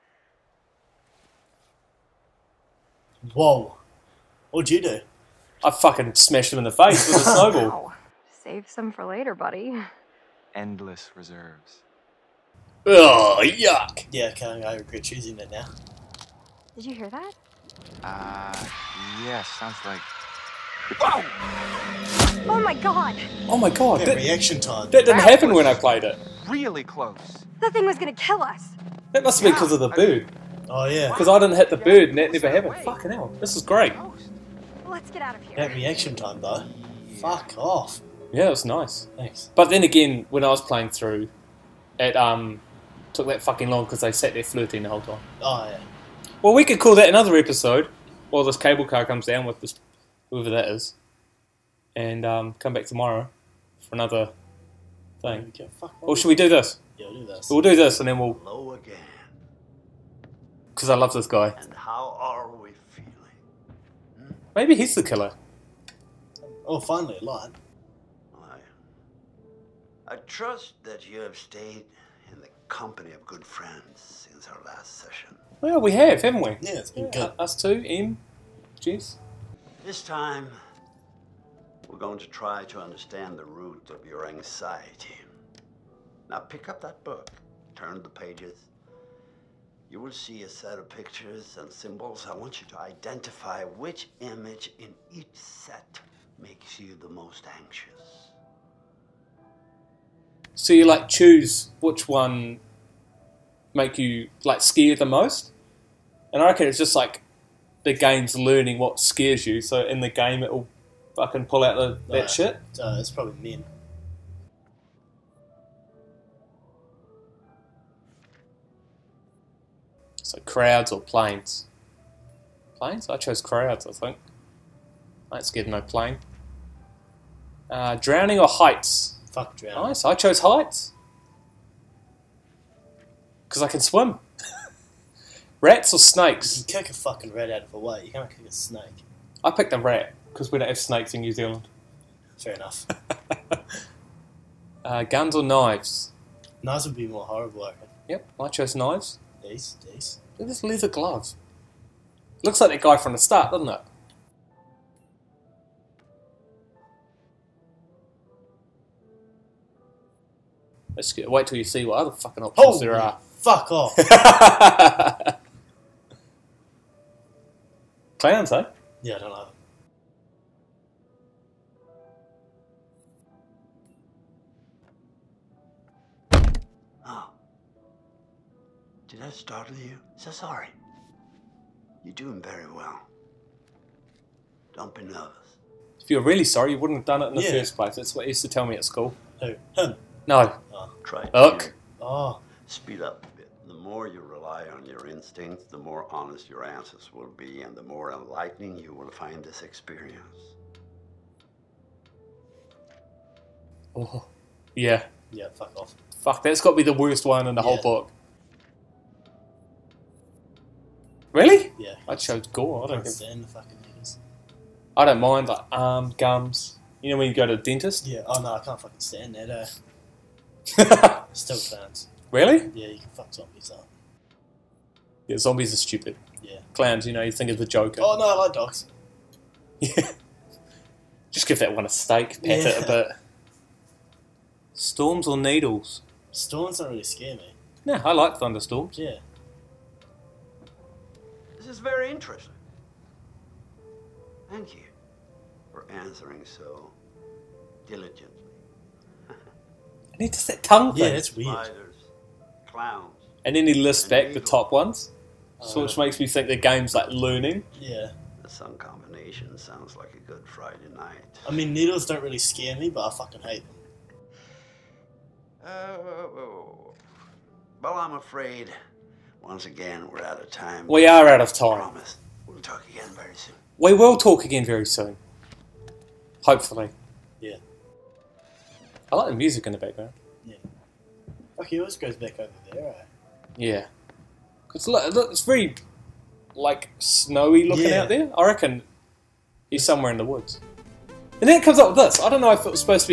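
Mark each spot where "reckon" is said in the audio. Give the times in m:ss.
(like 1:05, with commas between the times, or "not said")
1:46, 2:27, 4:48.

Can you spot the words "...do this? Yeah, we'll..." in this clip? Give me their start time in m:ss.
0:56.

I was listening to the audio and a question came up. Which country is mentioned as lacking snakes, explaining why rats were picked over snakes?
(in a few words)
New Zealand.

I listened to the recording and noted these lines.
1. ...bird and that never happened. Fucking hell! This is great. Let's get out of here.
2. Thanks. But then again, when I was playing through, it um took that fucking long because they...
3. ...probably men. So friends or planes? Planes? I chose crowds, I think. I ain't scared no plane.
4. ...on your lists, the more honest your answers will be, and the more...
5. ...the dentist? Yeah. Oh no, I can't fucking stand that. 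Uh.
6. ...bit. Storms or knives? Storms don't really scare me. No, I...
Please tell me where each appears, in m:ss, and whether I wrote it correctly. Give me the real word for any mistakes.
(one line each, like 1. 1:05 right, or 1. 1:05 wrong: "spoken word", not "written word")
1. 0:31 right
2. 0:39 right
3. 1:53 wrong: "crowds", not "friends"
4. 3:14 wrong: "instincts", not "lists"
5. 3:37 right
6. 3:52 wrong: "needles", not "knives".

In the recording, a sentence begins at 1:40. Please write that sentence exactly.
So you like choose which one make you like scare the most.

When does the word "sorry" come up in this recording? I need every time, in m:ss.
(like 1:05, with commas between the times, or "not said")
3:00, 3:06.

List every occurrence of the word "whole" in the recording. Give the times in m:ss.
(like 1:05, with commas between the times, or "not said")
0:44, 3:27.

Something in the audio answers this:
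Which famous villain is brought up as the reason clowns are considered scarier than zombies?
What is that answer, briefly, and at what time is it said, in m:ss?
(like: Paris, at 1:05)
The Joker, at 3:47.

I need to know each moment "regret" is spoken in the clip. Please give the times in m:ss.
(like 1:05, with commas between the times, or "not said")
0:14.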